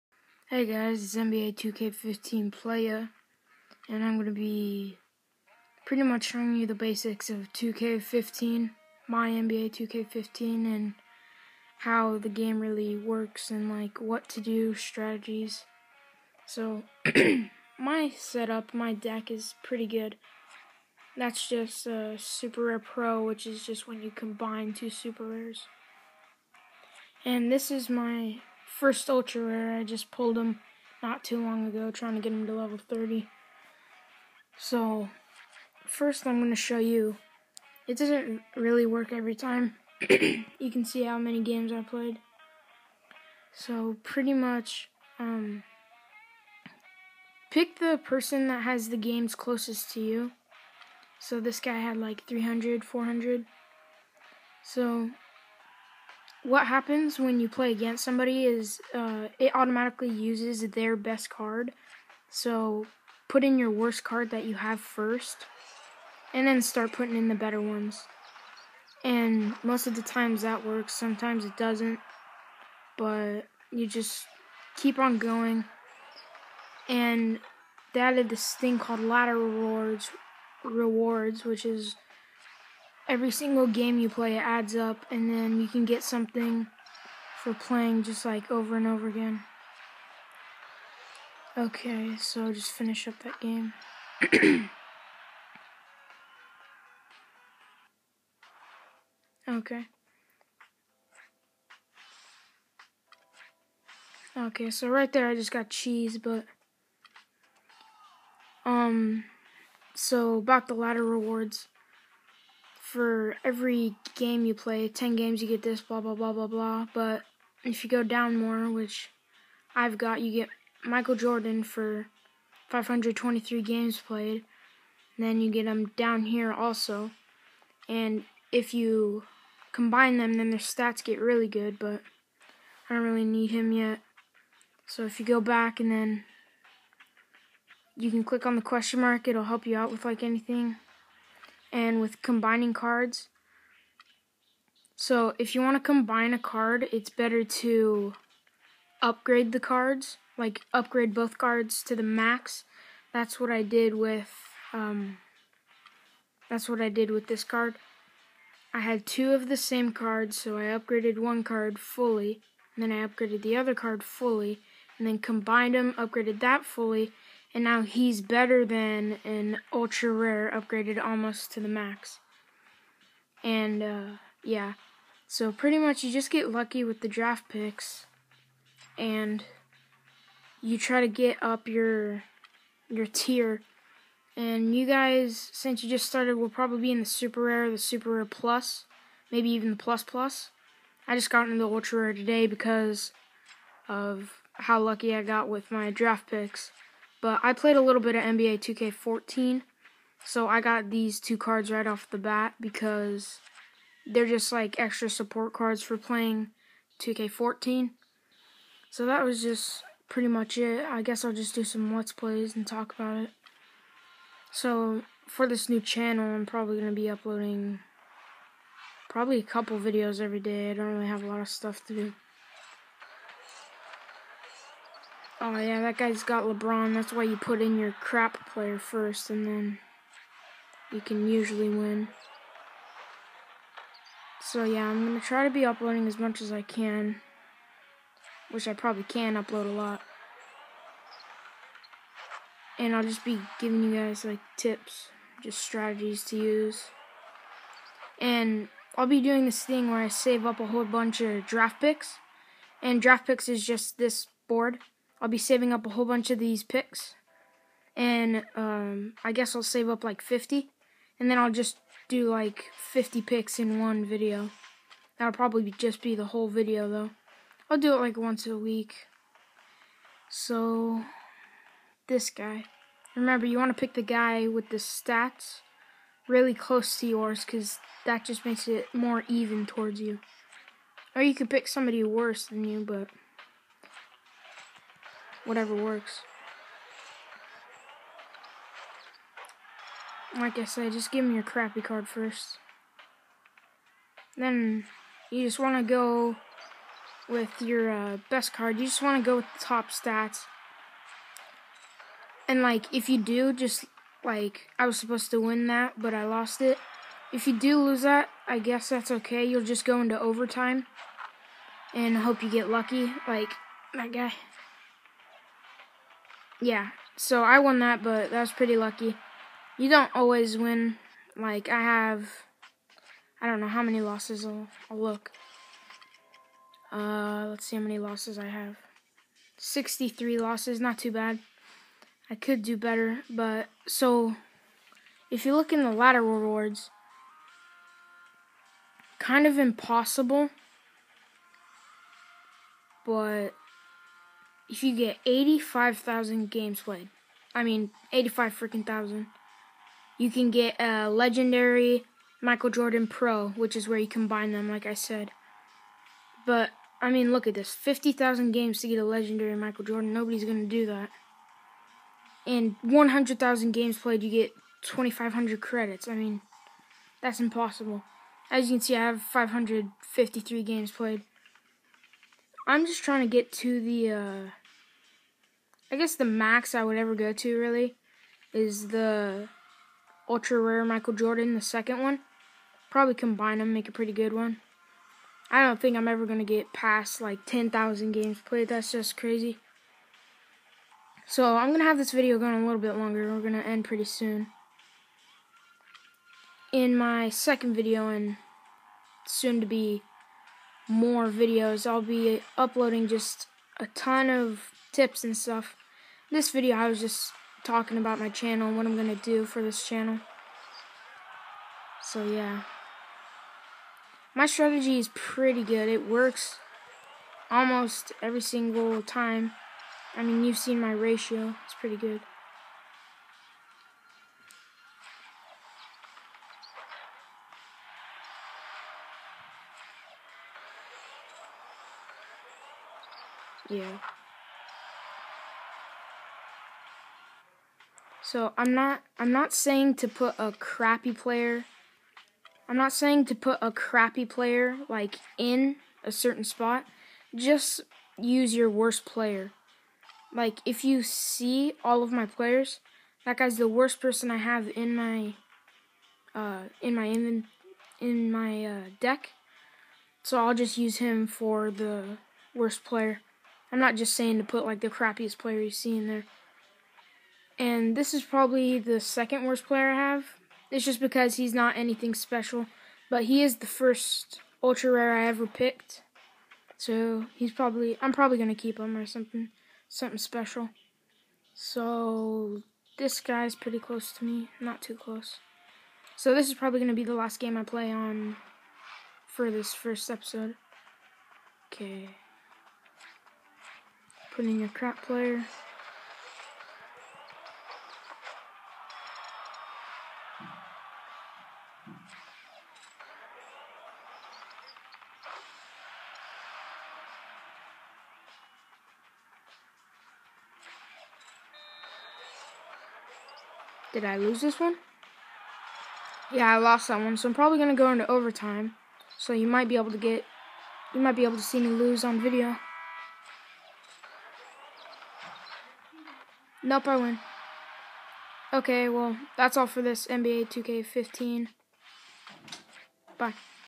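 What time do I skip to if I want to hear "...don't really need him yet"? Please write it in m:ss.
2:12.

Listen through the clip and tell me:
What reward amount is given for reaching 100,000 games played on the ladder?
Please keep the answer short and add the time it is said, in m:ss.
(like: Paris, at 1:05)
2,500 credits, at 6:04.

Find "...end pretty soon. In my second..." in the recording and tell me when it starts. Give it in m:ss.
6:33.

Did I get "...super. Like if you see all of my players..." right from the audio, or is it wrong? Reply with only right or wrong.
wrong.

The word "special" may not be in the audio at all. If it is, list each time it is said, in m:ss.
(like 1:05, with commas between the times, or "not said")
7:52, 8:00.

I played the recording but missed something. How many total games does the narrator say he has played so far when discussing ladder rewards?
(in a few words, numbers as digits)
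553.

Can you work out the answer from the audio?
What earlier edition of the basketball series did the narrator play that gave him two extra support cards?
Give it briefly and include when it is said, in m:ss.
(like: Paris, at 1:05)
NBA 2K14, at 3:18.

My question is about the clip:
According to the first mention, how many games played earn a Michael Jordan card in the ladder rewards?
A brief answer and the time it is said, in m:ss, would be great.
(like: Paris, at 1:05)
523, at 2:02.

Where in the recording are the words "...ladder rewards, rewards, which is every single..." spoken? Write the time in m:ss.
1:18.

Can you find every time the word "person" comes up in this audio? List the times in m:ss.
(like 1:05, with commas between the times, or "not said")
0:48, 7:33.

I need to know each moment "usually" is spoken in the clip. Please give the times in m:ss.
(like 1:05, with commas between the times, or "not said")
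3:51.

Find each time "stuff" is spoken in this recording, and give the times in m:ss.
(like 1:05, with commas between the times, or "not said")
3:41, 6:45.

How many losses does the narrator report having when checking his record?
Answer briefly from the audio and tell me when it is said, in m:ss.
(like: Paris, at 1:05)
63, at 5:29.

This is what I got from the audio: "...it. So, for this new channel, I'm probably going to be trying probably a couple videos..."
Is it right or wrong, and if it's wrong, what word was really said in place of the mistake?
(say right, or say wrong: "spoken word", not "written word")
wrong: "uploading", not "trying".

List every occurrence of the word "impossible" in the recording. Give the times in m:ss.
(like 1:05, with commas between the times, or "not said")
5:39, 6:07.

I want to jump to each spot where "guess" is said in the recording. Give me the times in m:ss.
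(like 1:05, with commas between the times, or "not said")
3:31, 4:19, 5:08, 6:15.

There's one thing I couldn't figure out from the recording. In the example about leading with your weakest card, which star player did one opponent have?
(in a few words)
LeBron.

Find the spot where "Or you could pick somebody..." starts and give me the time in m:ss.
4:41.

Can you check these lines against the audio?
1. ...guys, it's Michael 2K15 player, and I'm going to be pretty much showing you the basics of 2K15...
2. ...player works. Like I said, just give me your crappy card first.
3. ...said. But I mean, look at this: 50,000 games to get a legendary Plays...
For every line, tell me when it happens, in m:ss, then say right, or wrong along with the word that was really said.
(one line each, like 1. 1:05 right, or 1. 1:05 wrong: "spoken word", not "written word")
1. 0:00 wrong: "NBA", not "Michael"
2. 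4:45 wrong: "whatever", not "player"
3. 5:54 wrong: "Michael", not "Plays".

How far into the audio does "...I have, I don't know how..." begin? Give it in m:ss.
5:21.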